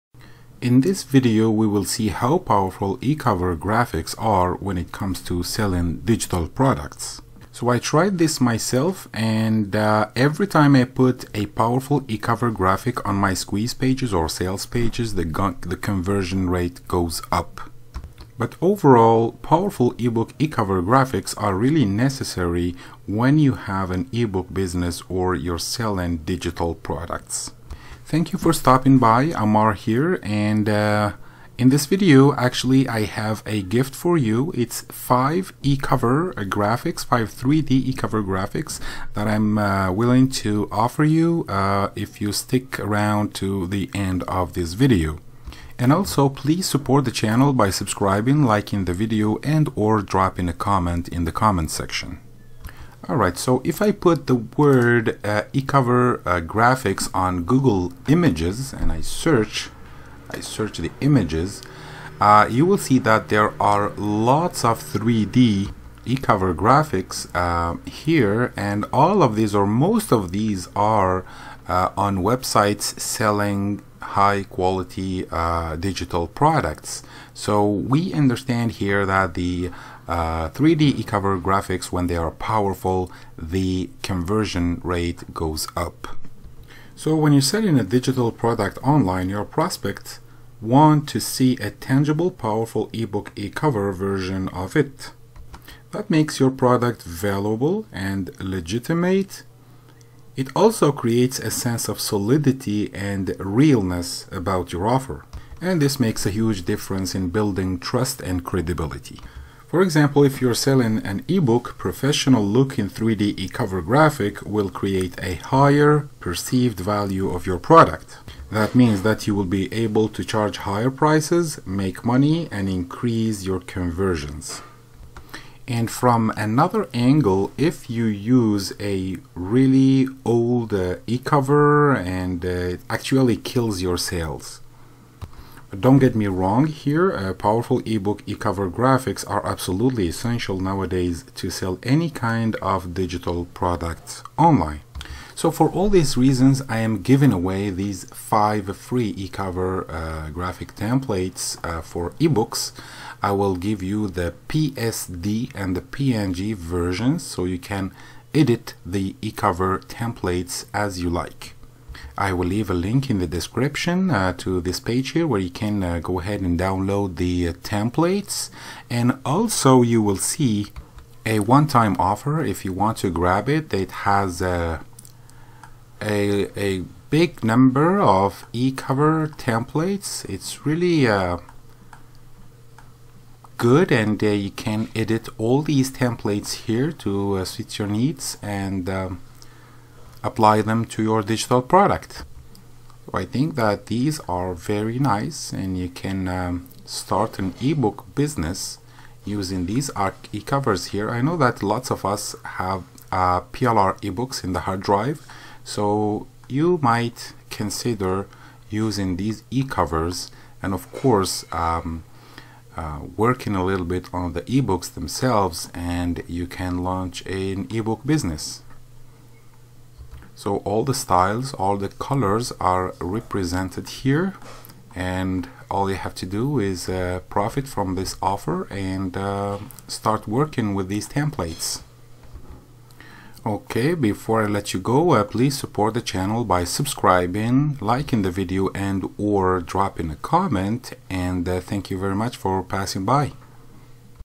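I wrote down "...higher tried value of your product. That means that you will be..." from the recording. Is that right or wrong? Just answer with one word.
wrong.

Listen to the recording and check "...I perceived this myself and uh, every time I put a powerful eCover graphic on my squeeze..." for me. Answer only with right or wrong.
wrong.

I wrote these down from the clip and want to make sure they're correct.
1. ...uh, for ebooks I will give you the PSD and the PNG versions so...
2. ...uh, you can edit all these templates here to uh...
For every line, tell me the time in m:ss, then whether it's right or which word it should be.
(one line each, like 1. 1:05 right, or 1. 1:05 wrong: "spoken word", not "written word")
1. 2:31 right
2. 3:04 right.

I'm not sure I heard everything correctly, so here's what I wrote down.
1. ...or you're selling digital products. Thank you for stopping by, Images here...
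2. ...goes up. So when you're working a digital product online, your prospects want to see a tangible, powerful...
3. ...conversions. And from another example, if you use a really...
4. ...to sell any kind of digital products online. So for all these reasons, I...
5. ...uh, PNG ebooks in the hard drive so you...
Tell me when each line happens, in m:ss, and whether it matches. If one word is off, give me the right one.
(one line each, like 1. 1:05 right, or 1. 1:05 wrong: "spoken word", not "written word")
1. 0:25 wrong: "Amar", not "Images"
2. 1:25 wrong: "selling", not "working"
3. 2:03 wrong: "angle", not "example"
4. 2:21 right
5. 3:23 wrong: "PLR", not "PNG".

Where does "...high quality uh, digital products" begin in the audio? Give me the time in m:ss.
1:14.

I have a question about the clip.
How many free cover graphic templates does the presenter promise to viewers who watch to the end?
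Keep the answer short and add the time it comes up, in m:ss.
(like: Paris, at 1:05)
5, at 0:37.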